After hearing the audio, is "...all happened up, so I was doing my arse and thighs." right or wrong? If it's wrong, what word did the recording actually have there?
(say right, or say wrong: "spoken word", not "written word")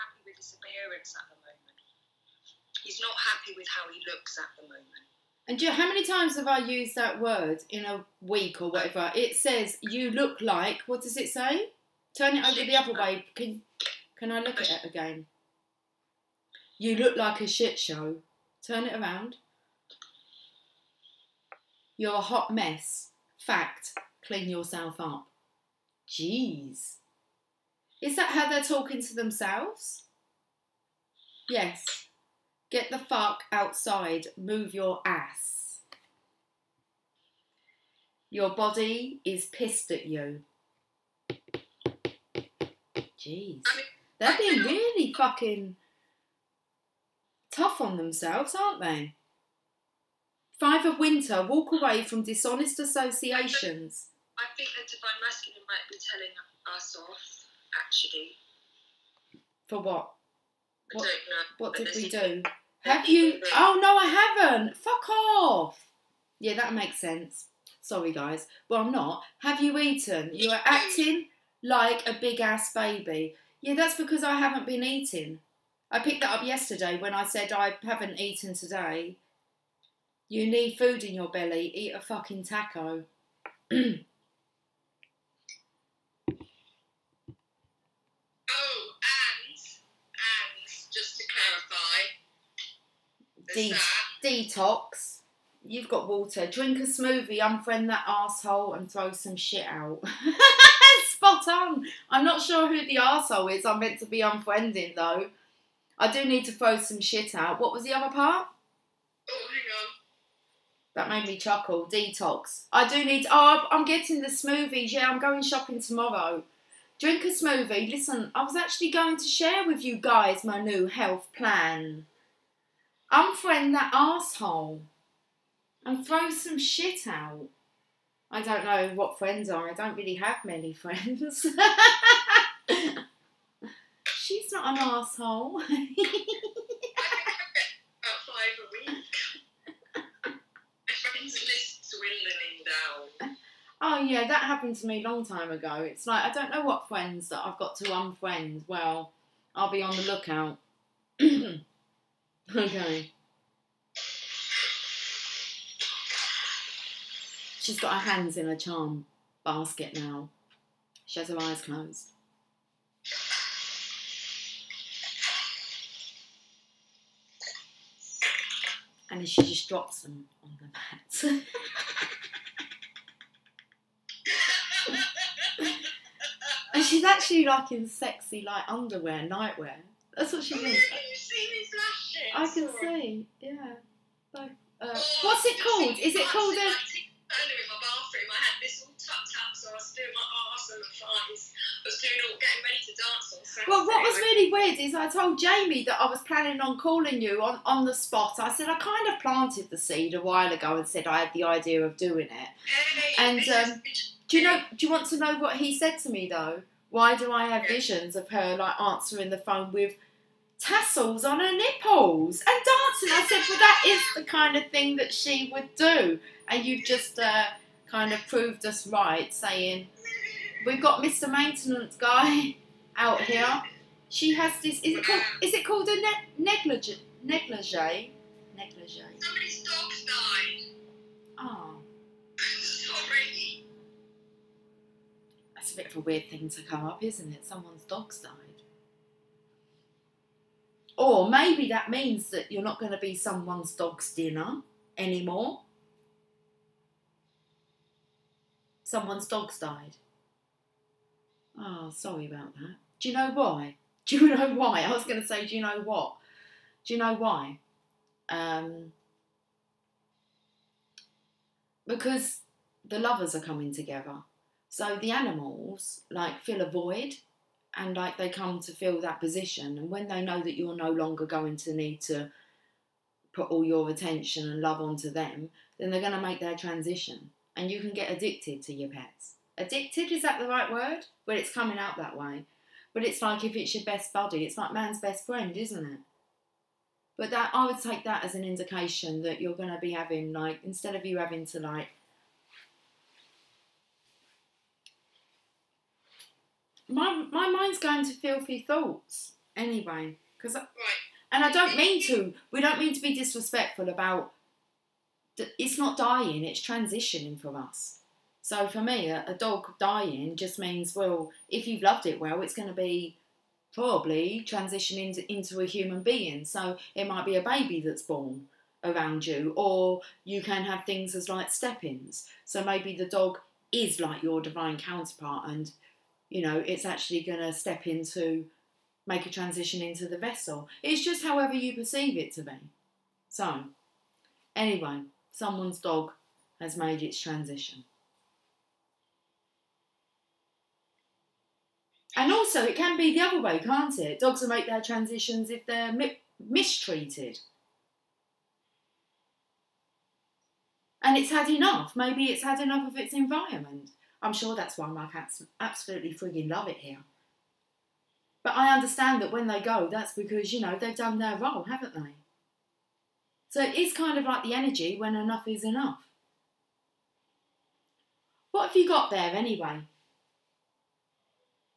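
wrong: "tucked", not "happened".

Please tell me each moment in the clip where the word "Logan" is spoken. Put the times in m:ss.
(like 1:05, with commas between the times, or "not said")
not said.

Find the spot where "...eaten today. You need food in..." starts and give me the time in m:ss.
1:18.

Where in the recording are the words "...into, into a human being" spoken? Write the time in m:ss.
5:15.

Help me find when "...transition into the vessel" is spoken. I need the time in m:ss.
5:29.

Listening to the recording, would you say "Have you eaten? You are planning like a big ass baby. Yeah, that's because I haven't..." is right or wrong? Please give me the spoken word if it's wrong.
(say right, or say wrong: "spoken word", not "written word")
wrong: "acting", not "planning".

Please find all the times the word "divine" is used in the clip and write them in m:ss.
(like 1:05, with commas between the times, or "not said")
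0:54, 5:24.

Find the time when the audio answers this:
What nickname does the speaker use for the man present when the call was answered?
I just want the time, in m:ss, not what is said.
3:41.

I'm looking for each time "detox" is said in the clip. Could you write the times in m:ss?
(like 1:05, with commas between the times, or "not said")
1:34, 1:51.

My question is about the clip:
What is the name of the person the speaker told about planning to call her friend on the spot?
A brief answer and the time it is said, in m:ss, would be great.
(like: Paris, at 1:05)
Jamie, at 3:15.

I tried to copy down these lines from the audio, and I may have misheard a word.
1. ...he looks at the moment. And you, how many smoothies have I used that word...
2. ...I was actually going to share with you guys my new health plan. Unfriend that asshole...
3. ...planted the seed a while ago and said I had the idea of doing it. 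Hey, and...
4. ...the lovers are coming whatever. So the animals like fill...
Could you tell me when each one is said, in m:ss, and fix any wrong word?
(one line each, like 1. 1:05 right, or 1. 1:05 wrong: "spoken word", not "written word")
1. 0:03 wrong: "times", not "smoothies"
2. 1:58 right
3. 3:19 right
4. 4:22 wrong: "together", not "whatever".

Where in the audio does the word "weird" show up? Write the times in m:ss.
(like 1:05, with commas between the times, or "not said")
3:14, 3:55.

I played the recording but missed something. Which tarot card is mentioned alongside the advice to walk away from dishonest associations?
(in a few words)
Five of winter.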